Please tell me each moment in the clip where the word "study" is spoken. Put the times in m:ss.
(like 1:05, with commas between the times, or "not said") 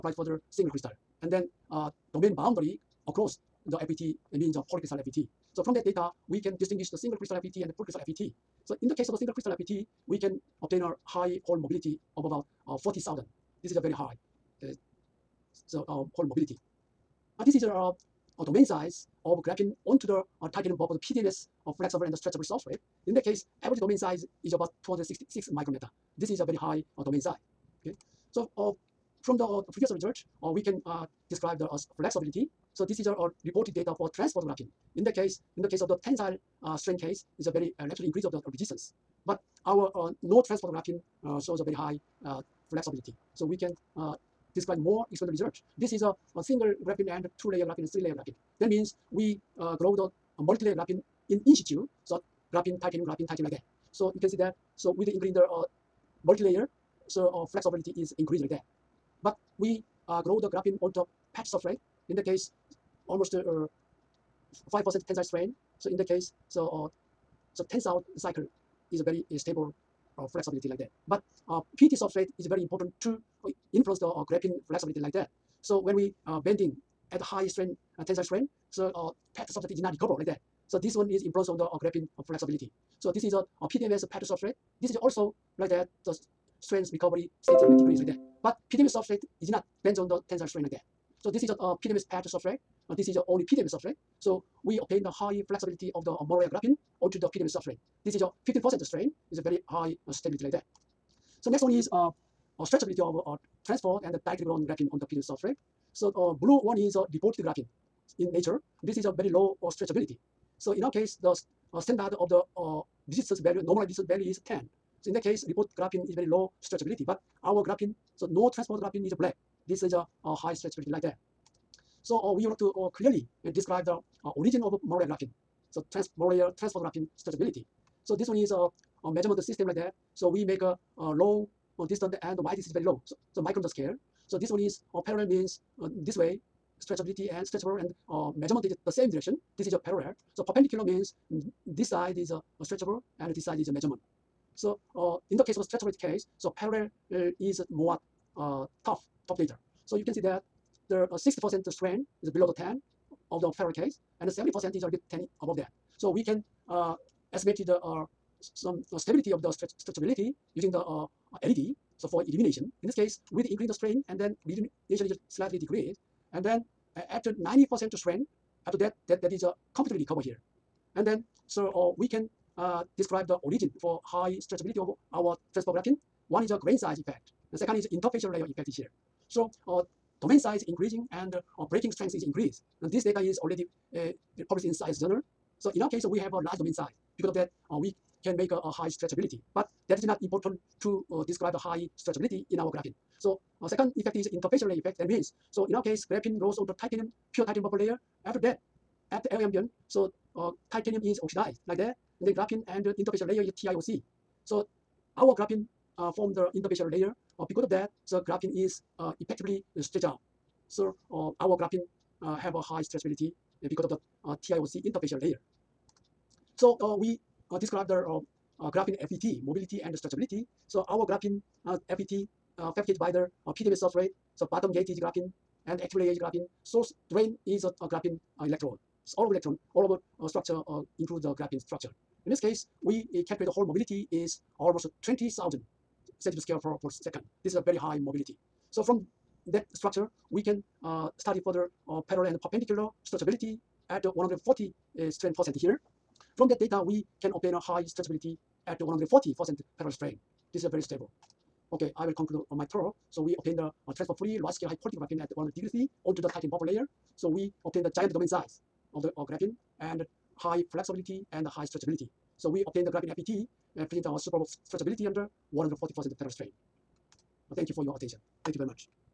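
4:01.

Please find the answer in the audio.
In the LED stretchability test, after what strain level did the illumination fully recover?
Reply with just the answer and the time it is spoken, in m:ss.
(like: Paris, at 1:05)
90%, at 2:47.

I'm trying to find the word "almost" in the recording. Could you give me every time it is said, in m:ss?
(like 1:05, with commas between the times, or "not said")
1:03, 3:54.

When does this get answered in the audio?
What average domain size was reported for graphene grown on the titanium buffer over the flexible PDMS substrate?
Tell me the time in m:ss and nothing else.
0:24.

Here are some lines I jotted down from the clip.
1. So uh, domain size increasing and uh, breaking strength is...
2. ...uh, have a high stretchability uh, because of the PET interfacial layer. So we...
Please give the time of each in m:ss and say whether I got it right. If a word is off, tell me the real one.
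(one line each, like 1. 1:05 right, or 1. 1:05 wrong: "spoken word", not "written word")
1. 2:59 right
2. 3:32 wrong: "TIOC", not "PET".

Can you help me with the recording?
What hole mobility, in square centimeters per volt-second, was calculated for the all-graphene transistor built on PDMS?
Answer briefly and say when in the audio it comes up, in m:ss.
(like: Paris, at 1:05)
20,000, at 3:55.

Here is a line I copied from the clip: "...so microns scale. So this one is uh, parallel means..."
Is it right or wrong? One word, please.
right.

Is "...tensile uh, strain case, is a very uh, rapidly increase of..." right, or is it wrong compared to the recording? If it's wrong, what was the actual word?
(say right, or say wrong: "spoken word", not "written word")
right.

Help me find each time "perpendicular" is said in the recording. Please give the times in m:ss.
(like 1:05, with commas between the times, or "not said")
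2:20, 4:02.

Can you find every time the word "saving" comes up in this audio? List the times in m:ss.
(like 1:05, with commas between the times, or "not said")
not said.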